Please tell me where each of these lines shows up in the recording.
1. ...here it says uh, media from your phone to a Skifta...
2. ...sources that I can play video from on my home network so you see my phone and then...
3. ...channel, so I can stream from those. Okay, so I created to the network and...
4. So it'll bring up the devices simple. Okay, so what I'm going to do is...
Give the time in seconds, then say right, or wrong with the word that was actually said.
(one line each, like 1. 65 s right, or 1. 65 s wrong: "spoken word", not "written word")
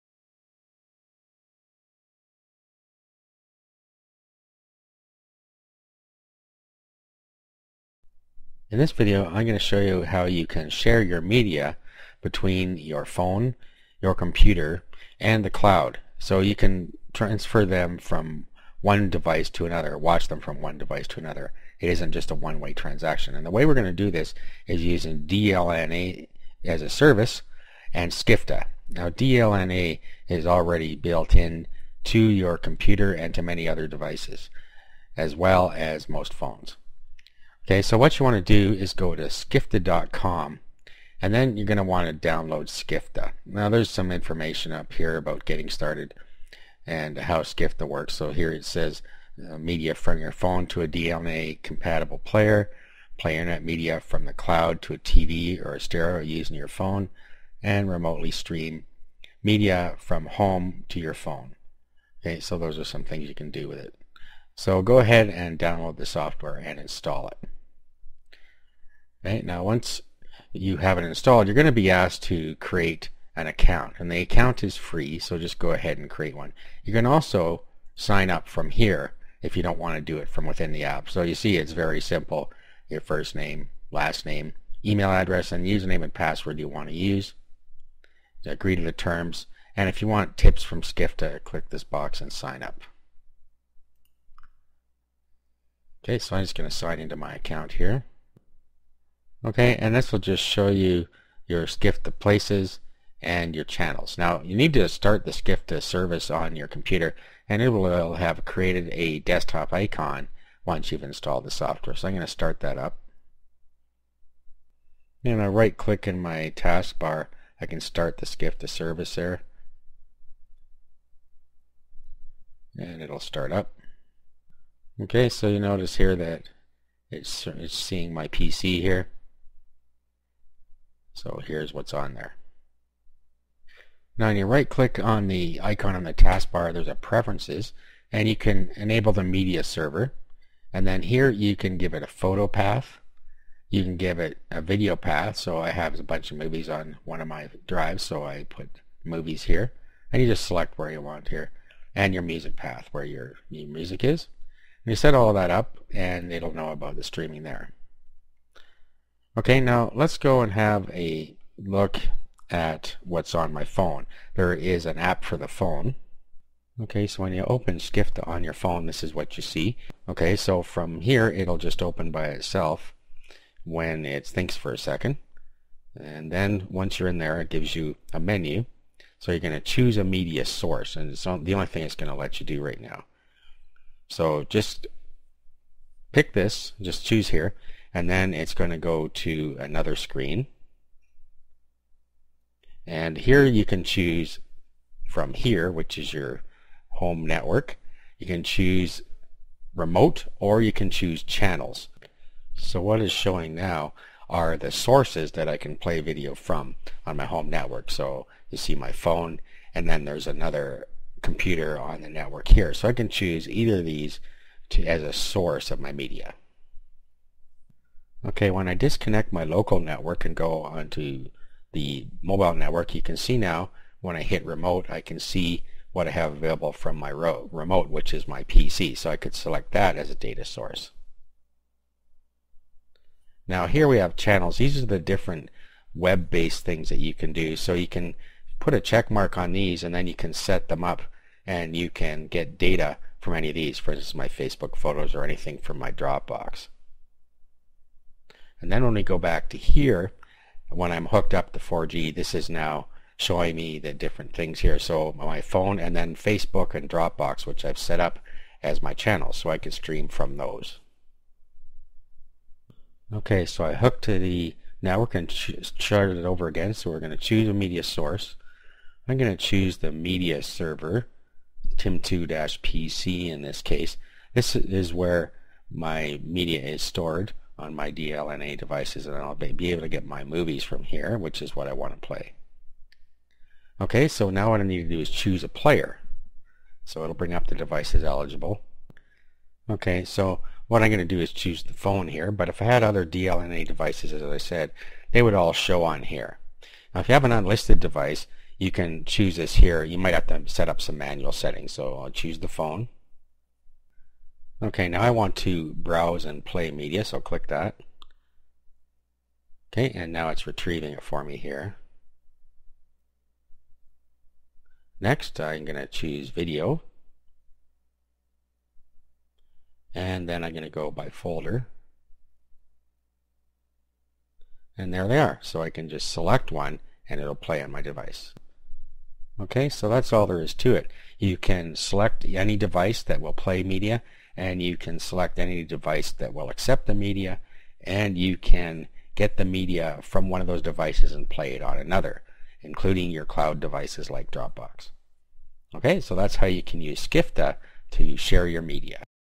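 1. 48 s wrong: "DLNA", not "Skifta"
2. 204 s right
3. 258 s wrong: "hooked", not "created"
4. 286 s wrong: "eligible", not "simple".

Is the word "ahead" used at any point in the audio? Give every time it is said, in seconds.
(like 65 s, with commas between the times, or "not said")
64 s, 75 s.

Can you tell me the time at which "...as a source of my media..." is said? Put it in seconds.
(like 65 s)
214 s.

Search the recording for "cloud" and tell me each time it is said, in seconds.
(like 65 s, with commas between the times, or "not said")
15 s, 54 s, 343 s.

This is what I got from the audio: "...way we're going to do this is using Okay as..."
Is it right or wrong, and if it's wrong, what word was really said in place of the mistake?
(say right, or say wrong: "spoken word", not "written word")
wrong: "DLNA", not "Okay".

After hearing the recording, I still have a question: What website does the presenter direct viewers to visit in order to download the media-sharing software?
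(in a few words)
skifta.com.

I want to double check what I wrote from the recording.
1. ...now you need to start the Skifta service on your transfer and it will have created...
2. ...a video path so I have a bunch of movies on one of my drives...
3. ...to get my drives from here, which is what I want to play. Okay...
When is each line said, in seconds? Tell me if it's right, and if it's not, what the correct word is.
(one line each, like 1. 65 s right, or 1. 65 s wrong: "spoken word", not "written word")
1. 104 s wrong: "computer", not "transfer"
2. 144 s right
3. 279 s wrong: "movies", not "drives".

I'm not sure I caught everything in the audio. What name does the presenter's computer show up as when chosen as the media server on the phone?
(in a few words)
tim2-pc.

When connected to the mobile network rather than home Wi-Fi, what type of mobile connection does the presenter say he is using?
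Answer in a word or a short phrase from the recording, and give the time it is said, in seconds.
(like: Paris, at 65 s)
4G, at 251 s.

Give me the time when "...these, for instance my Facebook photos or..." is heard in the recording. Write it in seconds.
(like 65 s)
243 s.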